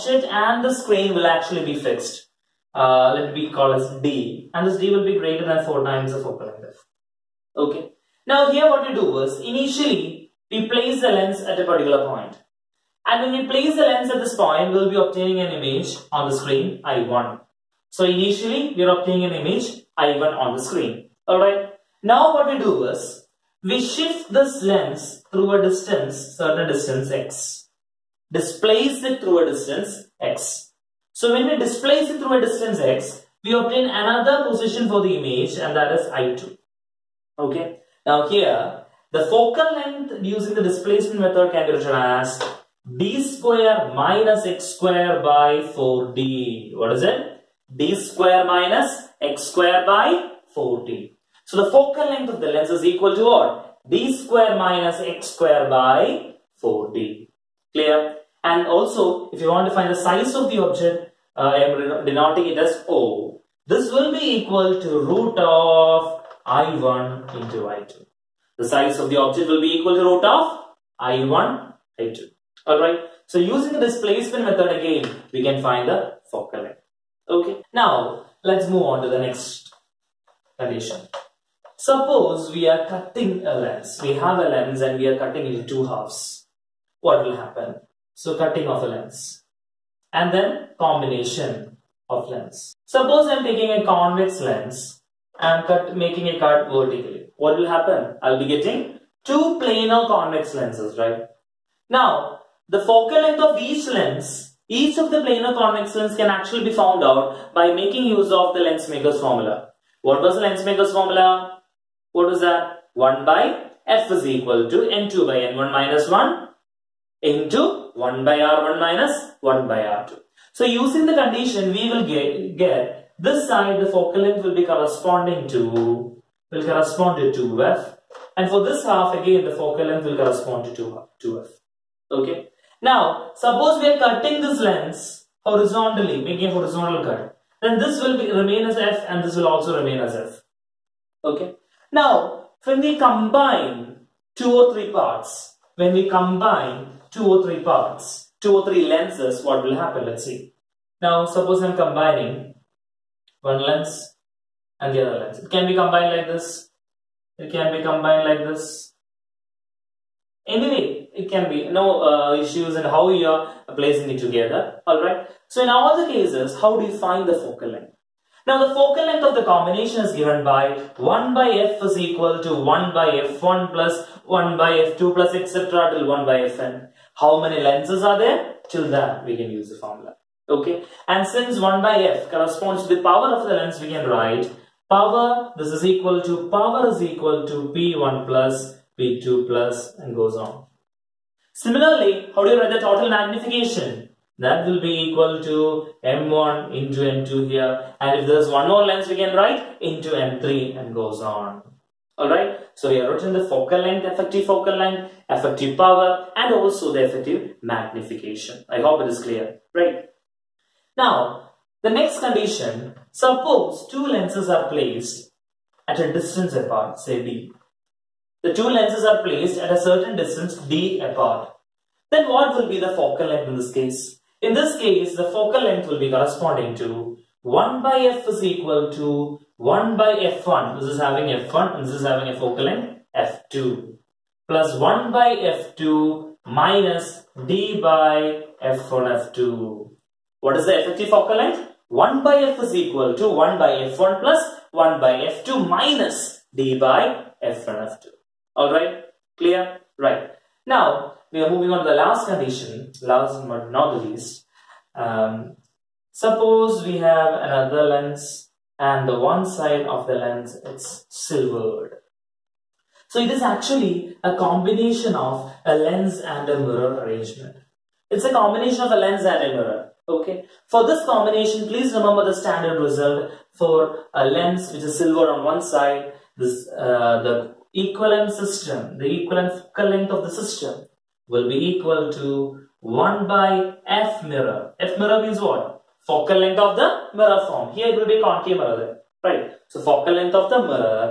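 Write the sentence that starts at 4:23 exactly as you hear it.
So it is actually a combination of a lens and a mirror arrangement.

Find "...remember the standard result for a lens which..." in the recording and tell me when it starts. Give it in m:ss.
4:31.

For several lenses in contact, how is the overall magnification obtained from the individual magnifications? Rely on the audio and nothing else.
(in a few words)
M1 into M2.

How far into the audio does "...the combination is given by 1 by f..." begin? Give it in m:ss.
2:49.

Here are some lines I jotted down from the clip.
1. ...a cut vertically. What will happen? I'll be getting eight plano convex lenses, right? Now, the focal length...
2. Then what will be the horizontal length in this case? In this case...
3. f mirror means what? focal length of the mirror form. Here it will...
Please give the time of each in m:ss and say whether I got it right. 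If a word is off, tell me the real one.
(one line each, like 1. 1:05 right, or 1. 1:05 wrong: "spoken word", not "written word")
1. 1:36 wrong: "two", not "eight"
2. 3:42 wrong: "focal", not "horizontal"
3. 4:44 right.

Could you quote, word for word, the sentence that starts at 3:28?
I hope it is clear, right?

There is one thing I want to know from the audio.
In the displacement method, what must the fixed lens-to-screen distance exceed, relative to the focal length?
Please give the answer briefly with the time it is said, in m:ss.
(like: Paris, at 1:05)
4 times the focal length, at 0:05.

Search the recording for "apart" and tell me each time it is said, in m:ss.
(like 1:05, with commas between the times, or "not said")
3:36, 3:40.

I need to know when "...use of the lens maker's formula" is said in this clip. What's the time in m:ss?
1:48.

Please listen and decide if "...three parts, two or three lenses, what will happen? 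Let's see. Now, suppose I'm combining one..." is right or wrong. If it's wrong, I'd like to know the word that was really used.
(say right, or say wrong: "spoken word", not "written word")
right.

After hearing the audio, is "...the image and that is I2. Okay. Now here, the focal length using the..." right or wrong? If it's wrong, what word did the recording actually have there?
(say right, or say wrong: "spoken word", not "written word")
right.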